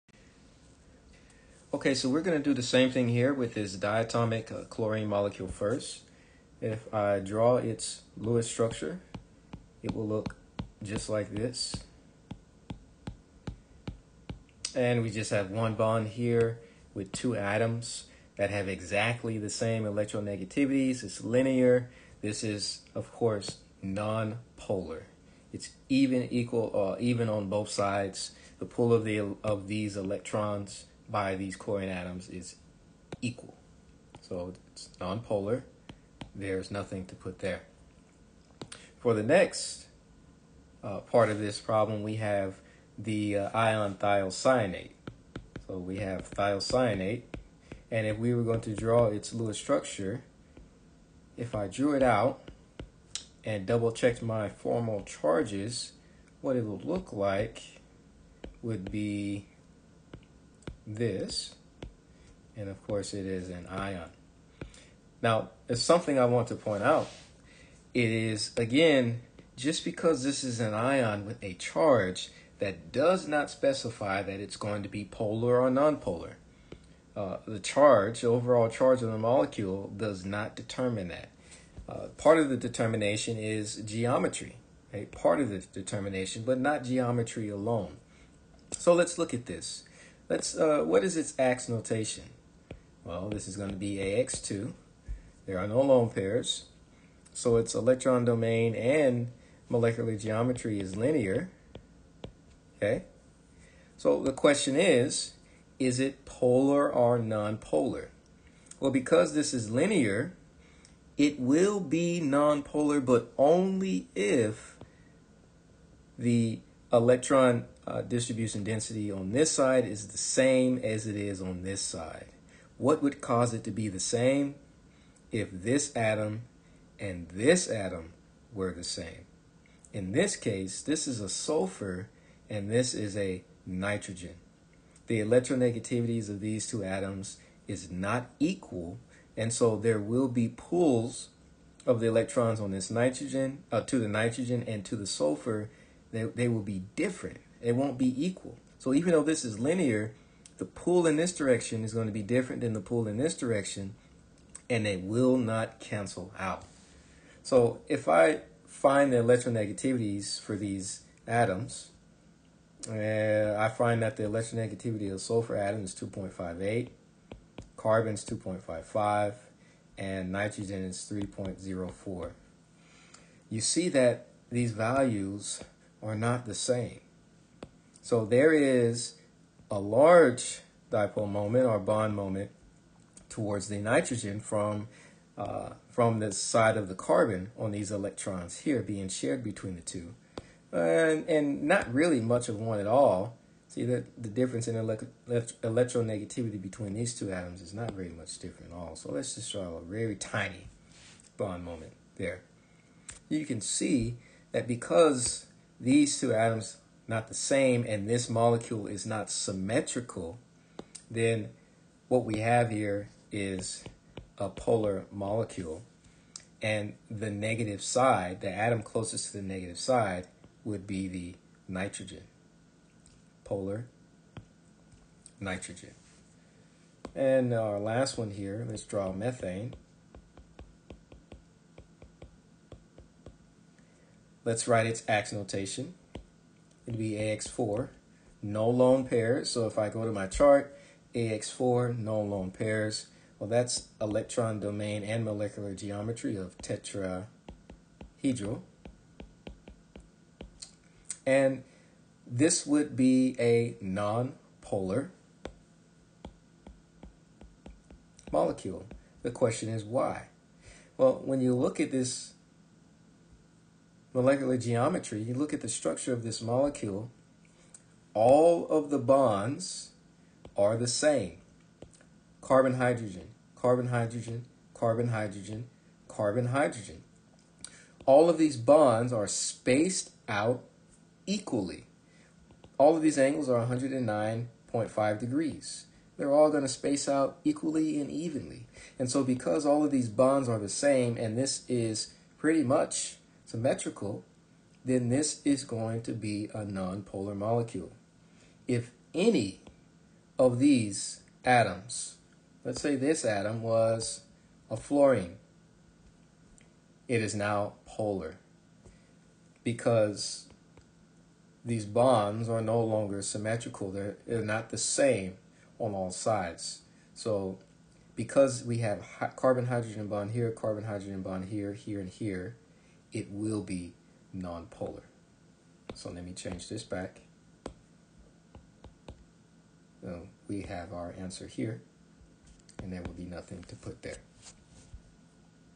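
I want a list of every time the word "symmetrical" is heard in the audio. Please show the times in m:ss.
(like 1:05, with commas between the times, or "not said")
3:29, 4:53, 5:13.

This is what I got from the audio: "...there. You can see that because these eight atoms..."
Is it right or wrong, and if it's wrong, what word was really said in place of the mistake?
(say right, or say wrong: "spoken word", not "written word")
wrong: "two", not "eight".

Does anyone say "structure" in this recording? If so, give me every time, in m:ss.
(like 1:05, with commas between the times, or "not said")
0:08, 0:49, 4:25.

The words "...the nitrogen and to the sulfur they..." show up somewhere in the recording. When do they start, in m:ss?
2:23.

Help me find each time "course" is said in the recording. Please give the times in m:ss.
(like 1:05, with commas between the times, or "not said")
0:23, 1:02.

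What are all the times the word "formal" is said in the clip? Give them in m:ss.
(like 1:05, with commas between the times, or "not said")
0:54.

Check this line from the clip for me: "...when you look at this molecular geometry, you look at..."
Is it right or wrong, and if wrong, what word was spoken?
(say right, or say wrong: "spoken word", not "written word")
right.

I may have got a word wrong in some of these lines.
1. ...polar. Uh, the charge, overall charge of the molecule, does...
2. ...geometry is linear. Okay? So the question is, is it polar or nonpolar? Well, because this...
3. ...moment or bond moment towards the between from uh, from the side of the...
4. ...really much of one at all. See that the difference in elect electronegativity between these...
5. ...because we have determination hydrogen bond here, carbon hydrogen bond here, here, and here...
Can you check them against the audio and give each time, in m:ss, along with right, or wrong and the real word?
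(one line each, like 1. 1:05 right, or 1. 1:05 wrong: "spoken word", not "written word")
1. 1:15 wrong: "nonpolar", not "polar"
2. 1:40 right
3. 3:01 wrong: "nitrogen", not "between"
4. 3:11 right
5. 5:18 wrong: "carbon", not "determination".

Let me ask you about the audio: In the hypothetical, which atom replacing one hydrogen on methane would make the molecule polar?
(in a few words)
fluorine.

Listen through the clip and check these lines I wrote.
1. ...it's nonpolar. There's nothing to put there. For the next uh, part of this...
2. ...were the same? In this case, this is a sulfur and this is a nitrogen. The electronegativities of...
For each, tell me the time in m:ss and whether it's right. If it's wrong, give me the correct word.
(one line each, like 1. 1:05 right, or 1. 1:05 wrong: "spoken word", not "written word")
1. 0:34 right
2. 2:08 right.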